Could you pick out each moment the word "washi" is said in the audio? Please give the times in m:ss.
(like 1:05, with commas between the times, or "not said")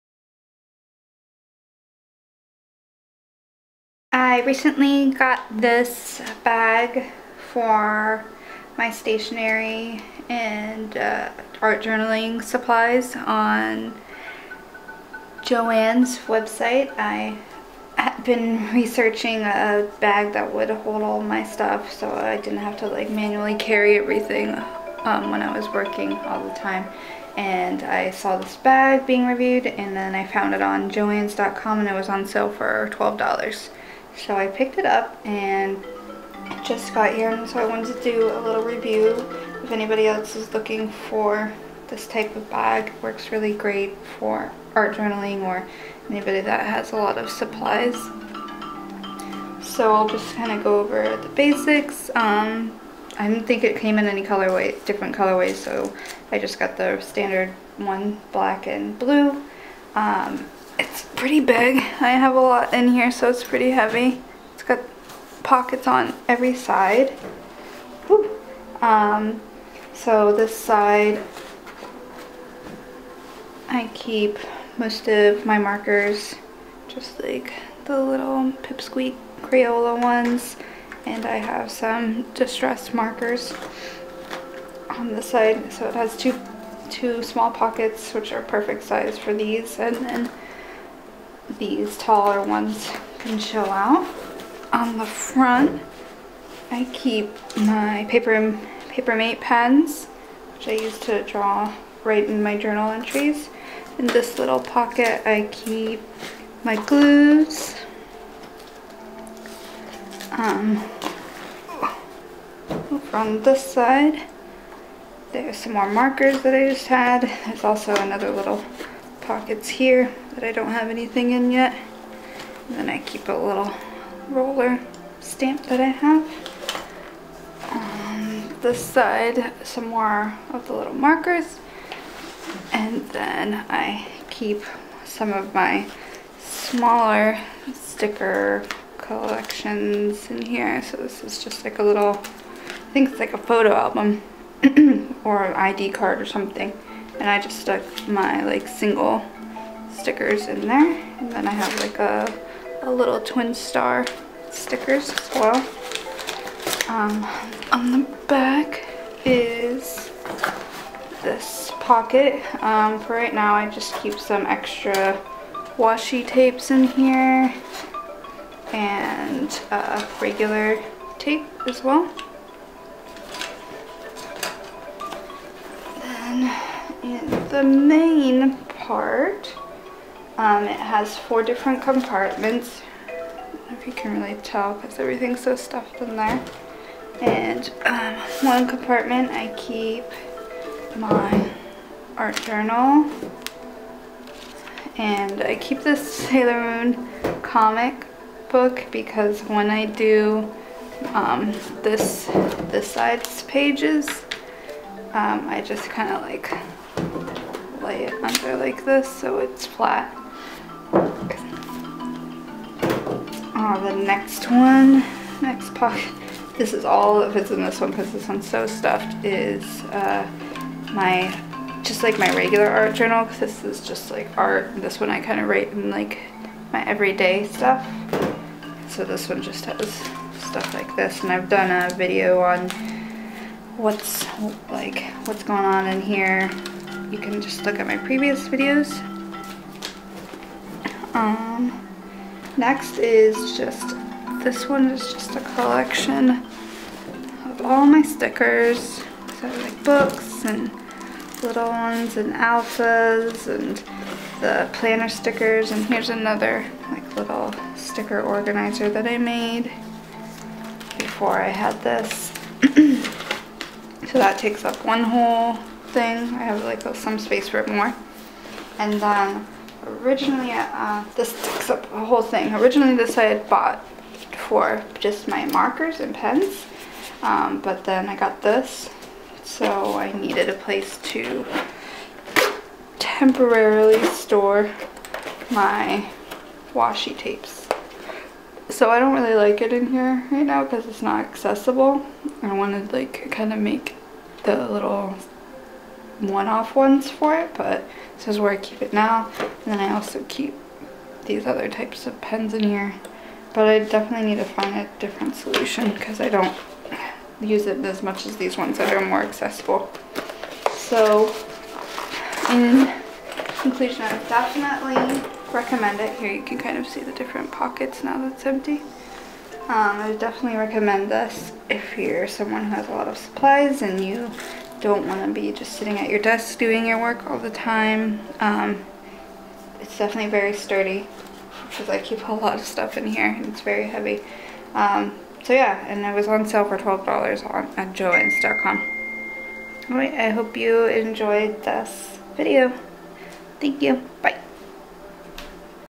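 2:45, 4:46.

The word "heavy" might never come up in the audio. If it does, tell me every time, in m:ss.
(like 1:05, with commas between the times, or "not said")
1:03, 5:33.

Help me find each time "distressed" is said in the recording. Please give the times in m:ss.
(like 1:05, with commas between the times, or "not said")
1:22.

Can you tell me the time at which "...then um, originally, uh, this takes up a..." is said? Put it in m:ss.
4:28.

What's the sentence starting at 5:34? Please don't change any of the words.
Um, so yeah, and it was on sale for $12 on at joanns.com.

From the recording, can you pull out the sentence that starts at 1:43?
In this little pocket, I keep my glues, um, over on this side, there's some more markers that I just had.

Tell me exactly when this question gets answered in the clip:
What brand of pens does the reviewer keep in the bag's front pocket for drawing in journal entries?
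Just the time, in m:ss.
1:38.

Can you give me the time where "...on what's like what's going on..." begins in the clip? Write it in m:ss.
3:52.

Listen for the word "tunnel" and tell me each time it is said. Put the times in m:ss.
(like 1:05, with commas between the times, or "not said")
not said.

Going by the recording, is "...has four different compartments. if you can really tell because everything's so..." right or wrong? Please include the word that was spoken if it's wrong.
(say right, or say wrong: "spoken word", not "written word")
right.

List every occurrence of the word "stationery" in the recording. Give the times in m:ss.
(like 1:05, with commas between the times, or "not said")
0:08.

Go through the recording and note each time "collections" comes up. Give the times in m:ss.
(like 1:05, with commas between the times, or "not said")
2:18, 4:05.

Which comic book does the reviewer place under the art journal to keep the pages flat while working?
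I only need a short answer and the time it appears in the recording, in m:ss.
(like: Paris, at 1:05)
Sailor Moon, at 3:16.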